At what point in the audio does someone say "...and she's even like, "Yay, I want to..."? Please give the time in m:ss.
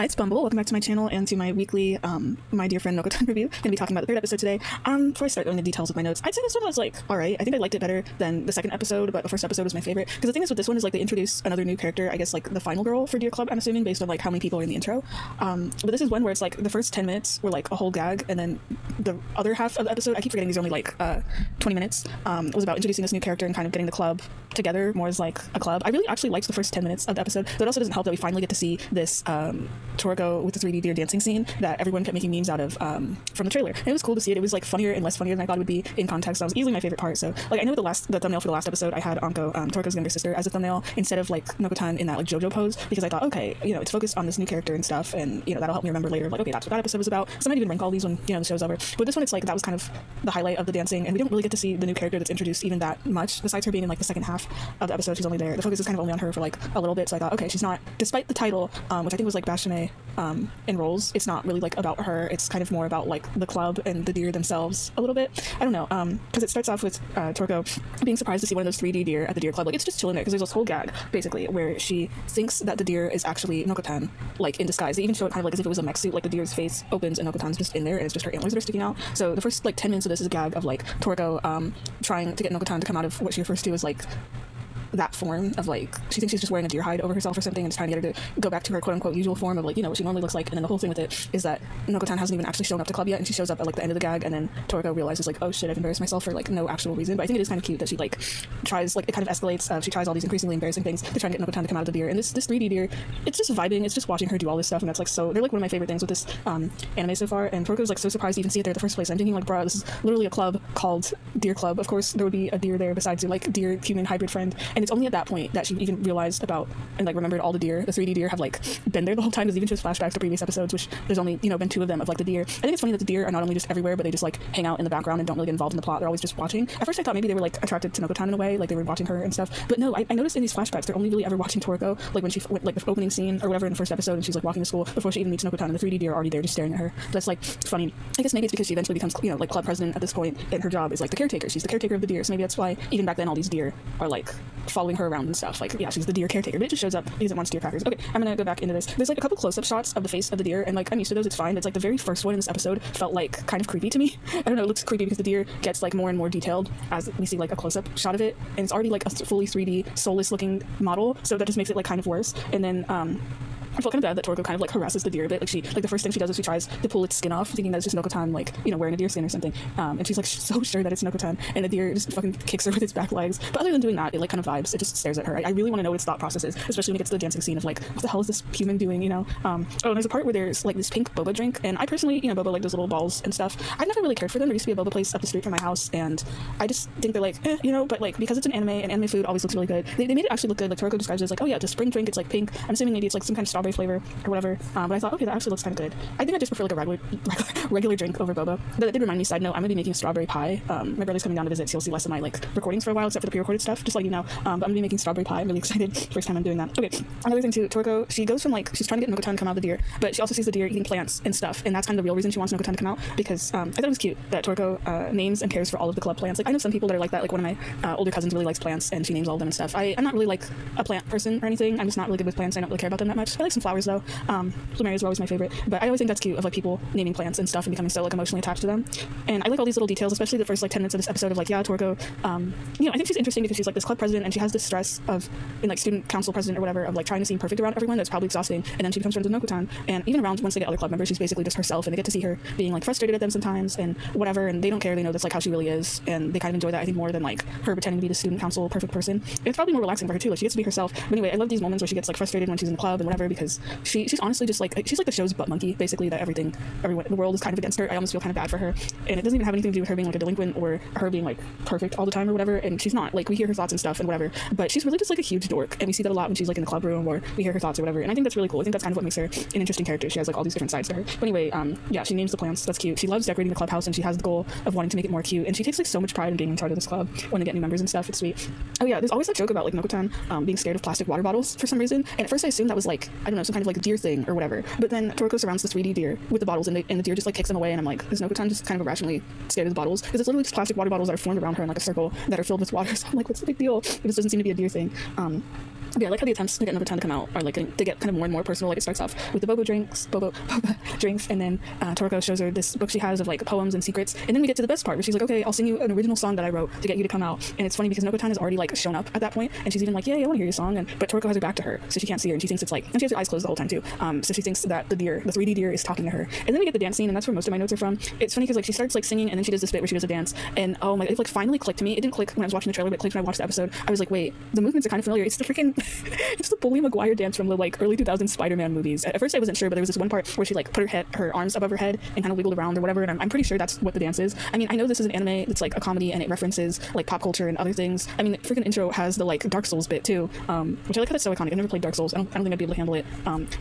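5:09.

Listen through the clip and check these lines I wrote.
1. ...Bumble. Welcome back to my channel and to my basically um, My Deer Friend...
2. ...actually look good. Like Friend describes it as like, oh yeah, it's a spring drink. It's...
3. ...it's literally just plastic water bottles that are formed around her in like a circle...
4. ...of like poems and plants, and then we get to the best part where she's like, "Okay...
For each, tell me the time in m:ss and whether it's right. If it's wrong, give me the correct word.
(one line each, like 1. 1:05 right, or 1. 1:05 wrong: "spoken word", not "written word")
1. 0:00 wrong: "weekly", not "basically"
2. 3:10 wrong: "Toriko", not "Friend"
3. 4:50 right
4. 5:03 wrong: "secrets", not "plants".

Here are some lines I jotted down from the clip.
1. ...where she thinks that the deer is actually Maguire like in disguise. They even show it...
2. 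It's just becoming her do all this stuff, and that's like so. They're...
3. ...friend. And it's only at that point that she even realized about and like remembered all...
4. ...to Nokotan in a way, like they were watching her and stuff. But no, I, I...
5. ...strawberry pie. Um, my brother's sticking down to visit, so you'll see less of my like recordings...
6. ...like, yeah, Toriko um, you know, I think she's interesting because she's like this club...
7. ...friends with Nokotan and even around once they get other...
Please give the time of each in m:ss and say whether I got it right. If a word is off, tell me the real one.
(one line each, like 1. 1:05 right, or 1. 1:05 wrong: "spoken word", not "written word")
1. 1:11 wrong: "Nokotan", not "Maguire"
2. 1:43 wrong: "watching", not "becoming"
3. 1:54 right
4. 2:07 right
5. 3:19 wrong: "coming", not "sticking"
6. 3:51 right
7. 3:59 right.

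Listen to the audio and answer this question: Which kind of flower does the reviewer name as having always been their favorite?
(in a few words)
Plumerias.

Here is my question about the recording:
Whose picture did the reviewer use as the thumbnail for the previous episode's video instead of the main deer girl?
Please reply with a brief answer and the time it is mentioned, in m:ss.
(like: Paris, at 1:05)
Anko, at 0:39.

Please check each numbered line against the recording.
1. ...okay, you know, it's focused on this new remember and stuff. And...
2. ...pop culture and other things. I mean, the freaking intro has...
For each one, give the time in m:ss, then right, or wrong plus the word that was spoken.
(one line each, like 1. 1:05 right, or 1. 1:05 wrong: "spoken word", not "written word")
1. 0:43 wrong: "character", not "remember"
2. 5:37 right.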